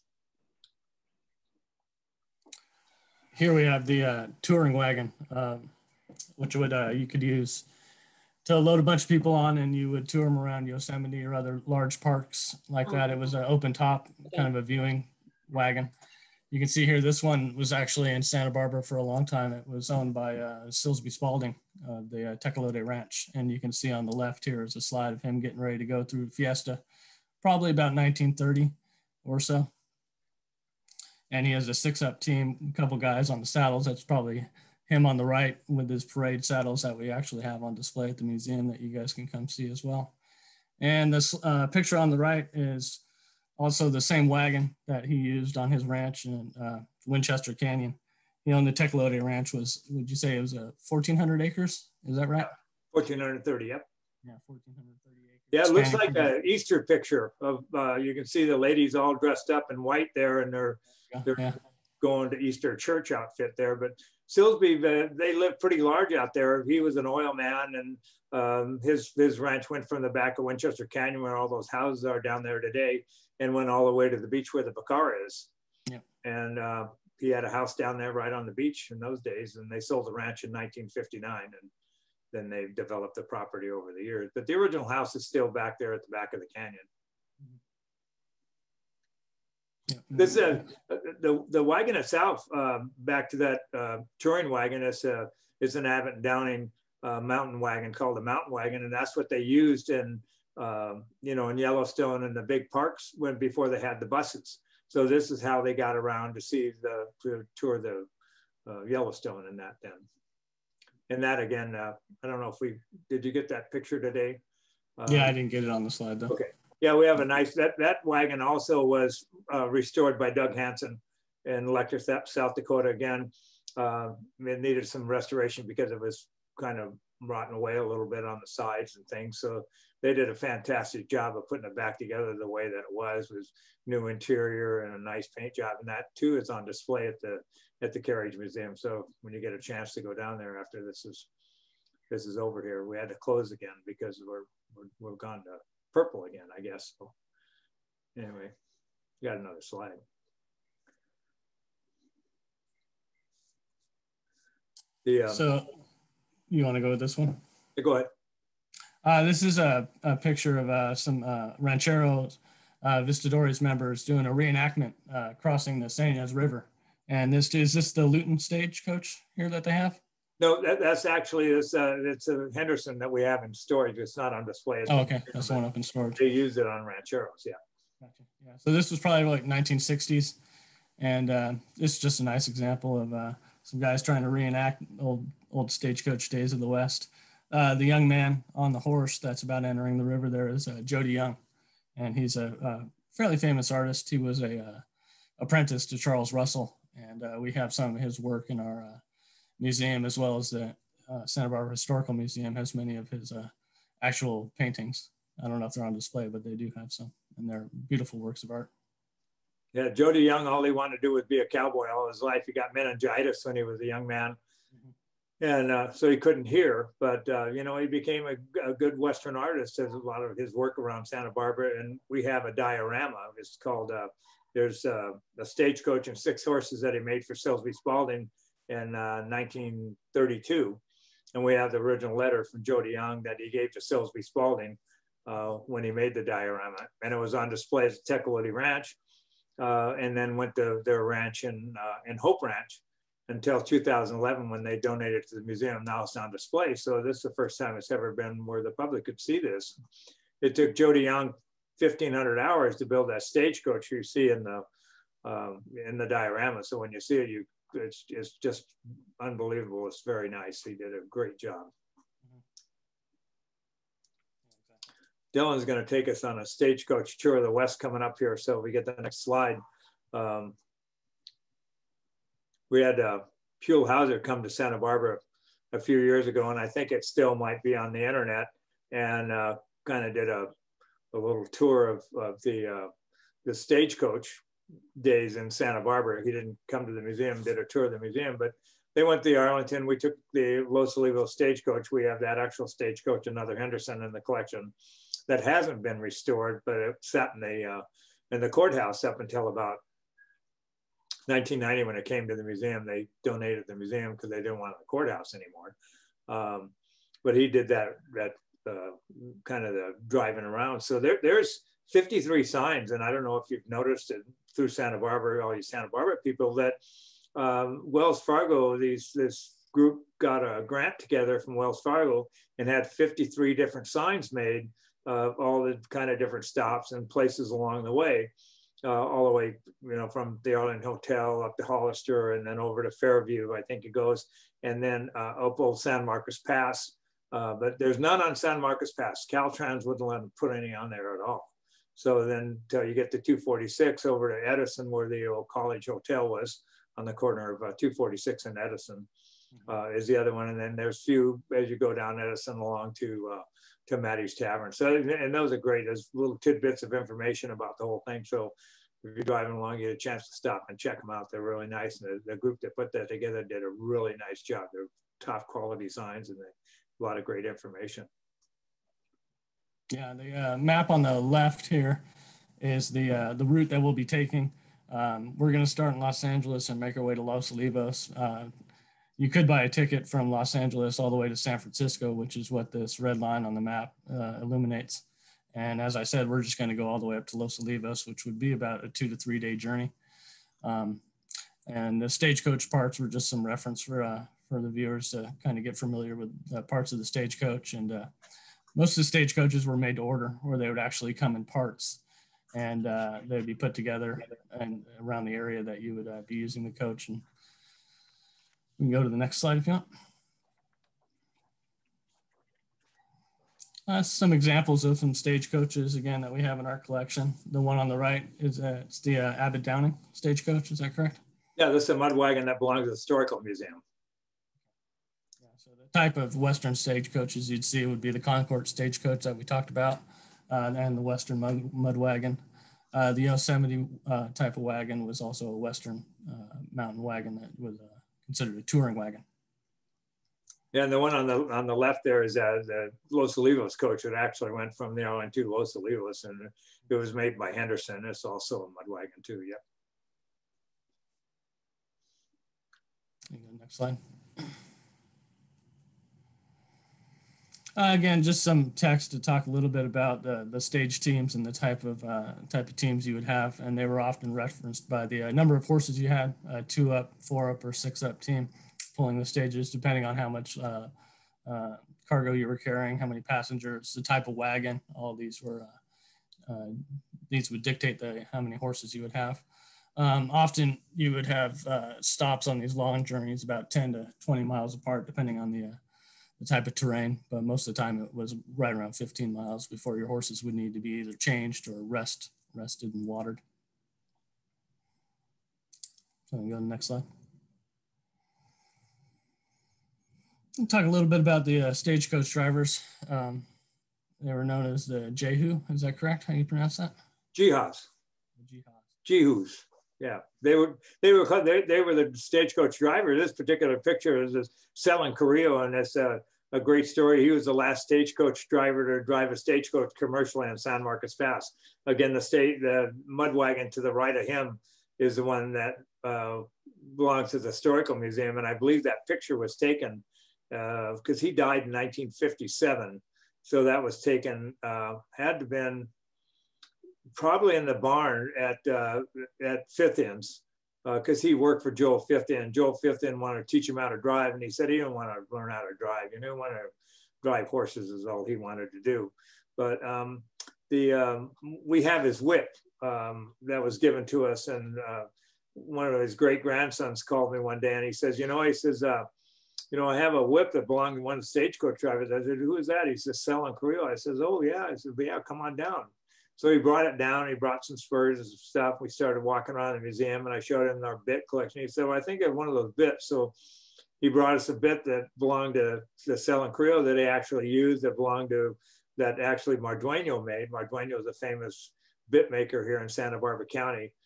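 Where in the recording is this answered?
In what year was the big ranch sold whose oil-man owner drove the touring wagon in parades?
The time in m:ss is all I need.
1:20.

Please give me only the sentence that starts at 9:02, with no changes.
Joel Fithian wanted to teach him how to drive, and he said he didn't want to learn how to drive.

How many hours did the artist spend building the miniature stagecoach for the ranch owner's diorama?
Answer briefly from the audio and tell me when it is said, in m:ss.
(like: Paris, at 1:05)
1,500, at 4:11.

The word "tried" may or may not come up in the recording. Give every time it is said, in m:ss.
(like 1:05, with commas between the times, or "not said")
not said.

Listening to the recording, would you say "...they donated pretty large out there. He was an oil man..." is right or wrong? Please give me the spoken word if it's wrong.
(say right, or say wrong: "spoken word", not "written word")
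wrong: "lived", not "donated".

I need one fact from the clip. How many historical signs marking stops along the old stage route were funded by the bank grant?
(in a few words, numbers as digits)
53.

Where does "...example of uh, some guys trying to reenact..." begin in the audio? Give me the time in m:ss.
3:02.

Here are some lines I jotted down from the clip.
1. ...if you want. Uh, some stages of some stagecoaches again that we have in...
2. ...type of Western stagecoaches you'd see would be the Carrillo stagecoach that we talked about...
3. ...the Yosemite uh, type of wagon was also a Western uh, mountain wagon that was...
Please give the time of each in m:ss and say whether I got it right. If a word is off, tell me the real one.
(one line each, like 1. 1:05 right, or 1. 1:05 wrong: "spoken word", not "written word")
1. 6:49 wrong: "examples", not "stages"
2. 7:05 wrong: "Concord", not "Carrillo"
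3. 7:13 right.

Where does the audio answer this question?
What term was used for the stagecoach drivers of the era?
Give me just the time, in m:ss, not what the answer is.
8:29.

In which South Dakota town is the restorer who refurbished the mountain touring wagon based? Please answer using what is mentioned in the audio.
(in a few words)
Letcher.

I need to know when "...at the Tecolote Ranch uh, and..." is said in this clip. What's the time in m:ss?
3:57.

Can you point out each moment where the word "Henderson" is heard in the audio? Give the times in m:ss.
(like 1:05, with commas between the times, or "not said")
2:52, 4:53, 7:27.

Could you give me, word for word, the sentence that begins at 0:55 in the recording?
Yeah, it looks like an Easter picture of.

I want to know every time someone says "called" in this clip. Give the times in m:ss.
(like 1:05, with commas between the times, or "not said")
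1:37, 3:43, 9:17.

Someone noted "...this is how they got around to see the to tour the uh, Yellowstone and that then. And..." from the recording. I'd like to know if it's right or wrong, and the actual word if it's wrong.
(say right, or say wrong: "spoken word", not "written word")
right.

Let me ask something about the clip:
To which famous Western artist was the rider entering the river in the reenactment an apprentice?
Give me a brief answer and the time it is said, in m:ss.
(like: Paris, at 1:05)
Charles Russell, at 3:15.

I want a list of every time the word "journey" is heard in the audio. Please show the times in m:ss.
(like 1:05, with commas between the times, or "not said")
6:29, 8:03.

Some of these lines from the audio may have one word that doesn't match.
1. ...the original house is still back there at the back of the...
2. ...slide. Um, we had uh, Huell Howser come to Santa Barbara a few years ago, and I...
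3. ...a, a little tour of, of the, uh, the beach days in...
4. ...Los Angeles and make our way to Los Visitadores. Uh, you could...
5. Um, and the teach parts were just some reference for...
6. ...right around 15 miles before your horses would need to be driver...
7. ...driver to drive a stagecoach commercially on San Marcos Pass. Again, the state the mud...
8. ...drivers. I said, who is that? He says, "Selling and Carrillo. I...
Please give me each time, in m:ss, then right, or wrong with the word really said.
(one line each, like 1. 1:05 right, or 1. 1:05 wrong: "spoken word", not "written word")
1. 1:24 right
2. 4:29 right
3. 4:40 wrong: "stagecoach", not "beach"
4. 6:15 wrong: "Olivos", not "Visitadores"
5. 6:30 wrong: "stagecoach", not "teach"
6. 8:08 wrong: "either", not "driver"
7. 8:38 right
8. 9:21 right.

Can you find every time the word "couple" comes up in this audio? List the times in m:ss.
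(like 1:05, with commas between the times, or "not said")
0:32.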